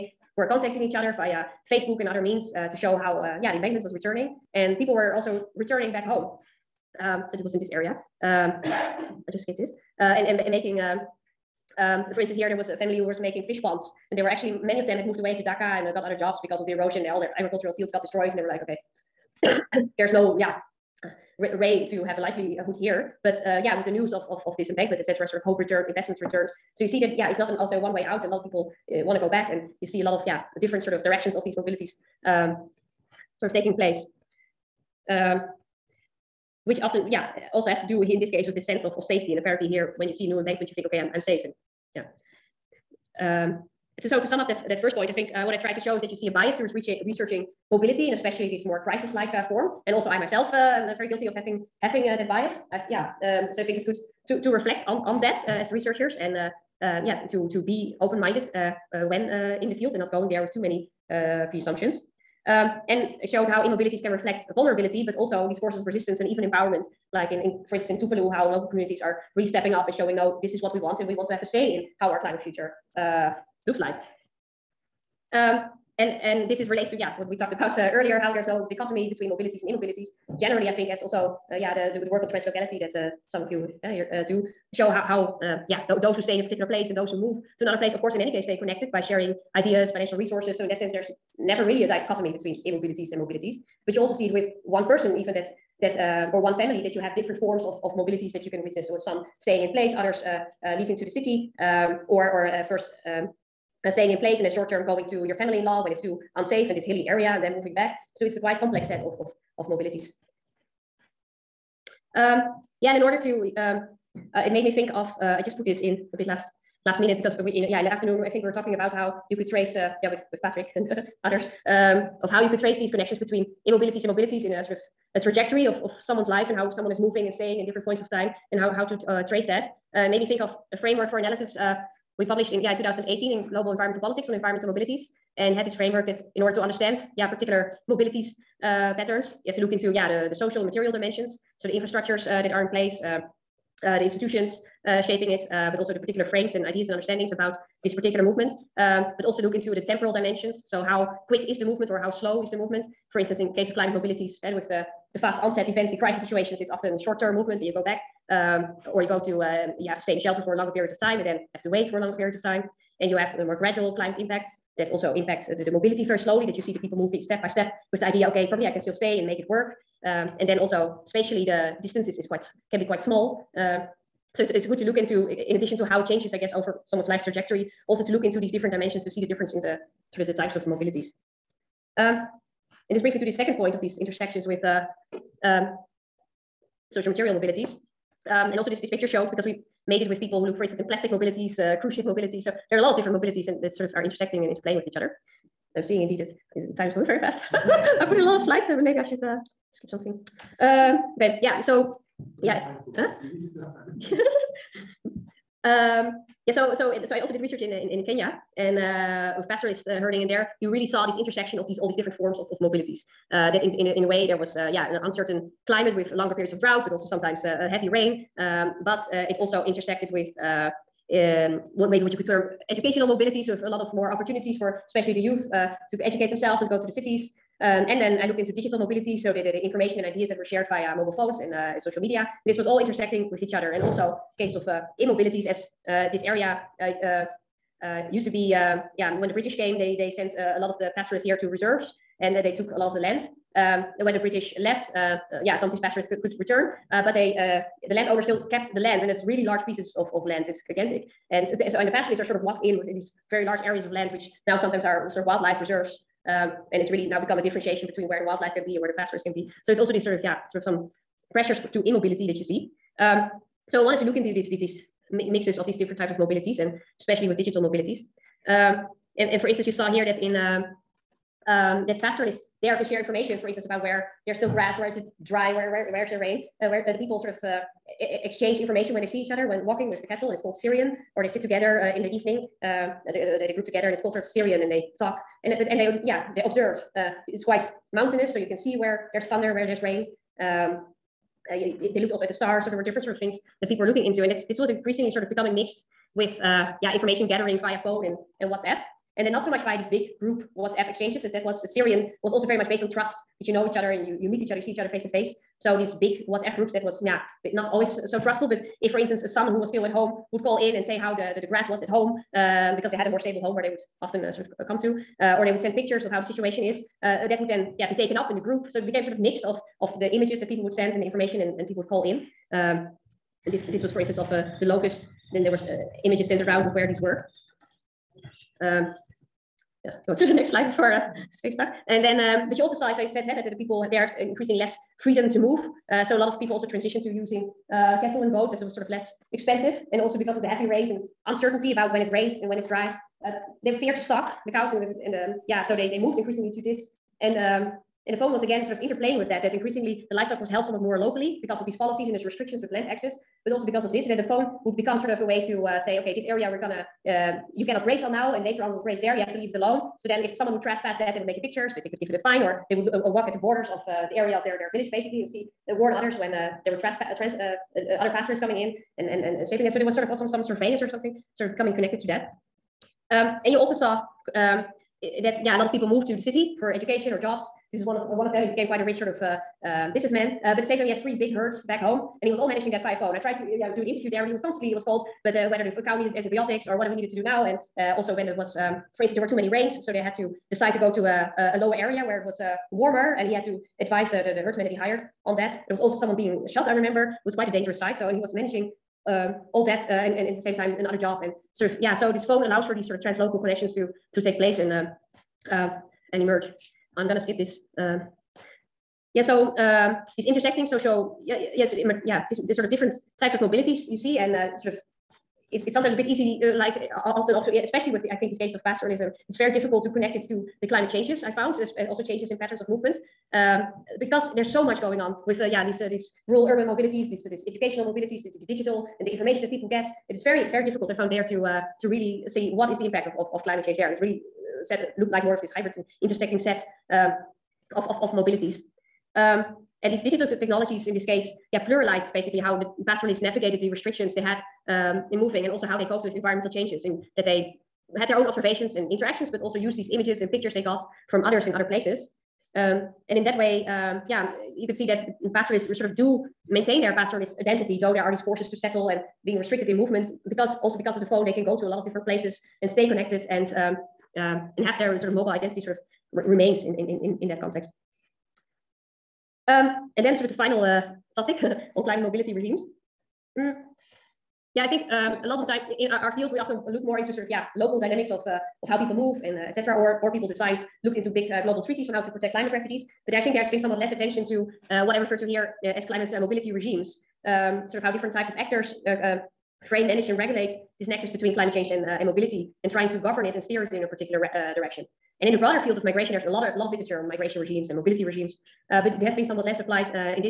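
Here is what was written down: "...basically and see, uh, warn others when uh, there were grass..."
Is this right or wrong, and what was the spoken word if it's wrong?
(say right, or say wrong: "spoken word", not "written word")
wrong: "trespass", not "grass".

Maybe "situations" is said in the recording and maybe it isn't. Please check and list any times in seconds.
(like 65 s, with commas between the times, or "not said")
156 s, 316 s.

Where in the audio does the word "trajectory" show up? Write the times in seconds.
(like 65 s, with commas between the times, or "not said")
125 s, 177 s.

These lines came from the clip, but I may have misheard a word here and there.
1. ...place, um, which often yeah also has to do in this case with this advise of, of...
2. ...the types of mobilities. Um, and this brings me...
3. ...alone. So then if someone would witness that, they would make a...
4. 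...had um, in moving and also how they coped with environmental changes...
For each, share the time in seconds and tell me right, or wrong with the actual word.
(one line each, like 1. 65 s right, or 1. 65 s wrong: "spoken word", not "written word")
1. 33 s wrong: "sense", not "advise"
2. 180 s right
3. 359 s wrong: "trespass", not "witness"
4. 444 s right.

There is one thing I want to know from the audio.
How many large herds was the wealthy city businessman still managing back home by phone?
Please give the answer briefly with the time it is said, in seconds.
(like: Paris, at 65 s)
3, at 381 s.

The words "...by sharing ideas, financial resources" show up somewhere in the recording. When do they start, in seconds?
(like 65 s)
88 s.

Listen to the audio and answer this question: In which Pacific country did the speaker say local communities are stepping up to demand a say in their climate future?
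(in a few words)
Tuvalu.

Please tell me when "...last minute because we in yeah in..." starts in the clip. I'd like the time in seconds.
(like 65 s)
116 s.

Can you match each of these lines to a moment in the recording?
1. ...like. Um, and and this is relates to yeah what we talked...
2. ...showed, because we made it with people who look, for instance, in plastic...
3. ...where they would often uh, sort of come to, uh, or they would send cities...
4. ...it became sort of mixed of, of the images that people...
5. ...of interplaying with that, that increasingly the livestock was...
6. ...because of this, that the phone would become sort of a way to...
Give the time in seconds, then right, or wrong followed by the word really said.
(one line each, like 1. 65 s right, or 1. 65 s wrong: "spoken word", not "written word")
1. 73 s right
2. 189 s right
3. 313 s wrong: "pictures", not "cities"
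4. 318 s right
5. 348 s right
6. 353 s right.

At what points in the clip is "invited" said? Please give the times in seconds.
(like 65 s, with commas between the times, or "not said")
not said.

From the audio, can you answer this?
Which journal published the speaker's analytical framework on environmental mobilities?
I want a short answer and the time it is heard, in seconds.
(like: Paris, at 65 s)
Global Environmental Politics, at 133 s.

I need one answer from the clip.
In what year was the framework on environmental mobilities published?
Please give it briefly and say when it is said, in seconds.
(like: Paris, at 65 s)
2018, at 132 s.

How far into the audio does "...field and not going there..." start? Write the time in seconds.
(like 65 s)
59 s.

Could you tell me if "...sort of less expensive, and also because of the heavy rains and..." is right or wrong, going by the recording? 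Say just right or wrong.
right.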